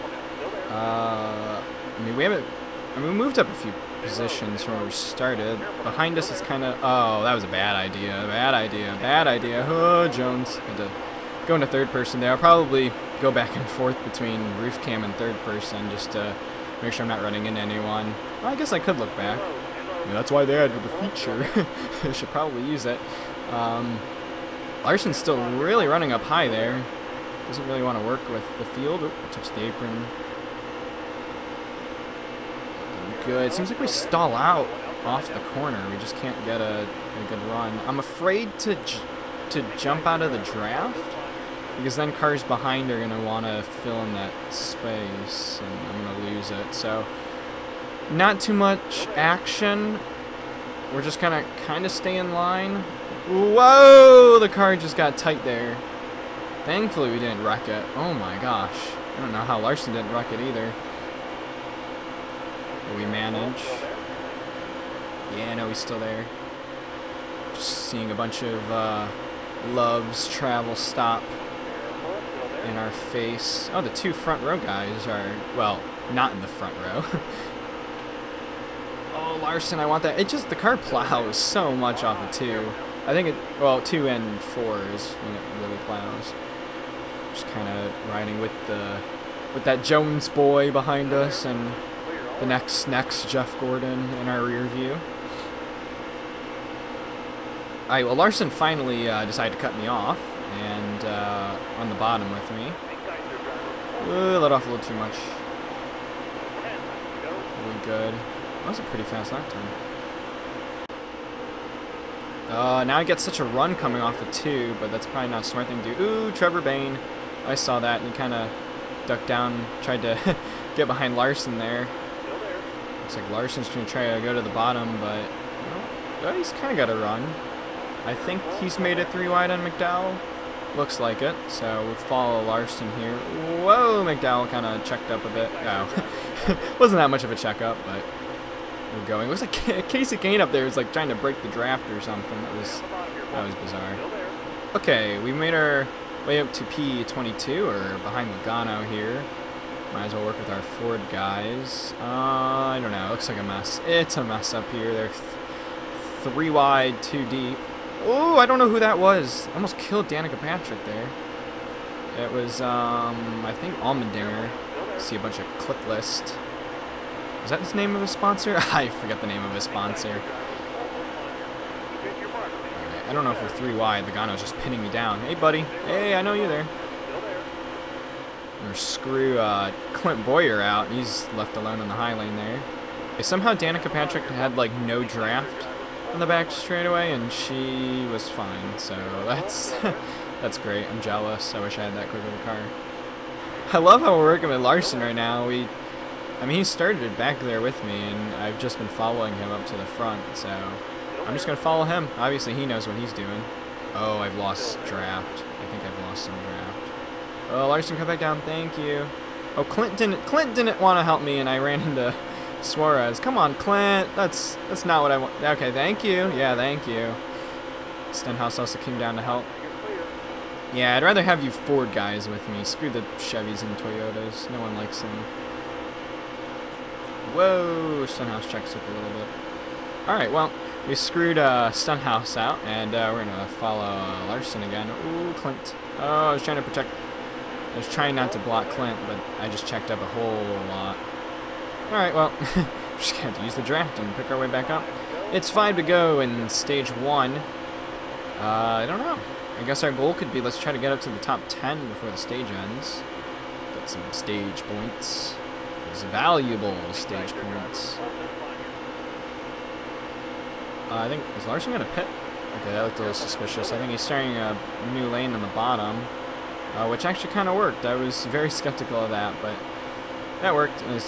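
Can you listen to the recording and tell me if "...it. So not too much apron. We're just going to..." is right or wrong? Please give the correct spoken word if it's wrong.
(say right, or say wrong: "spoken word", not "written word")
wrong: "action", not "apron".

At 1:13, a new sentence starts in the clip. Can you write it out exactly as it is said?
Oh, the two front row guys are, well, not in the front row.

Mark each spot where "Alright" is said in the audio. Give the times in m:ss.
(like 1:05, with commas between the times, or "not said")
3:50, 4:01.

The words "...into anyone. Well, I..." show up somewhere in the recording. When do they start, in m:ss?
0:17.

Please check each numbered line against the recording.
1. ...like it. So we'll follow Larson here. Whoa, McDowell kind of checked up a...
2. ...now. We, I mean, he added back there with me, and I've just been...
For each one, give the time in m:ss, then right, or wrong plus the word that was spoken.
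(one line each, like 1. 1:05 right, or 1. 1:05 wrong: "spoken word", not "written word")
1. 2:10 right
2. 3:15 wrong: "started", not "added".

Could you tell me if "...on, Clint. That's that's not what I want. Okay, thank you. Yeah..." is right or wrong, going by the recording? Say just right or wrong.
right.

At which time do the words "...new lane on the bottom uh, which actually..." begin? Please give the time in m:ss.
4:24.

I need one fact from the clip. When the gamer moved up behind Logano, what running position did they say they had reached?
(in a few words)
P22.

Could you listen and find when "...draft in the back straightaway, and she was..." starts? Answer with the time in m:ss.
3:05.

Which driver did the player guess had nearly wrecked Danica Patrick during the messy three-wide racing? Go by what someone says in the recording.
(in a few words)
Allmendinger.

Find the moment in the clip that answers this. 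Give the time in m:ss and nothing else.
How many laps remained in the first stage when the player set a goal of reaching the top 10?
4:05.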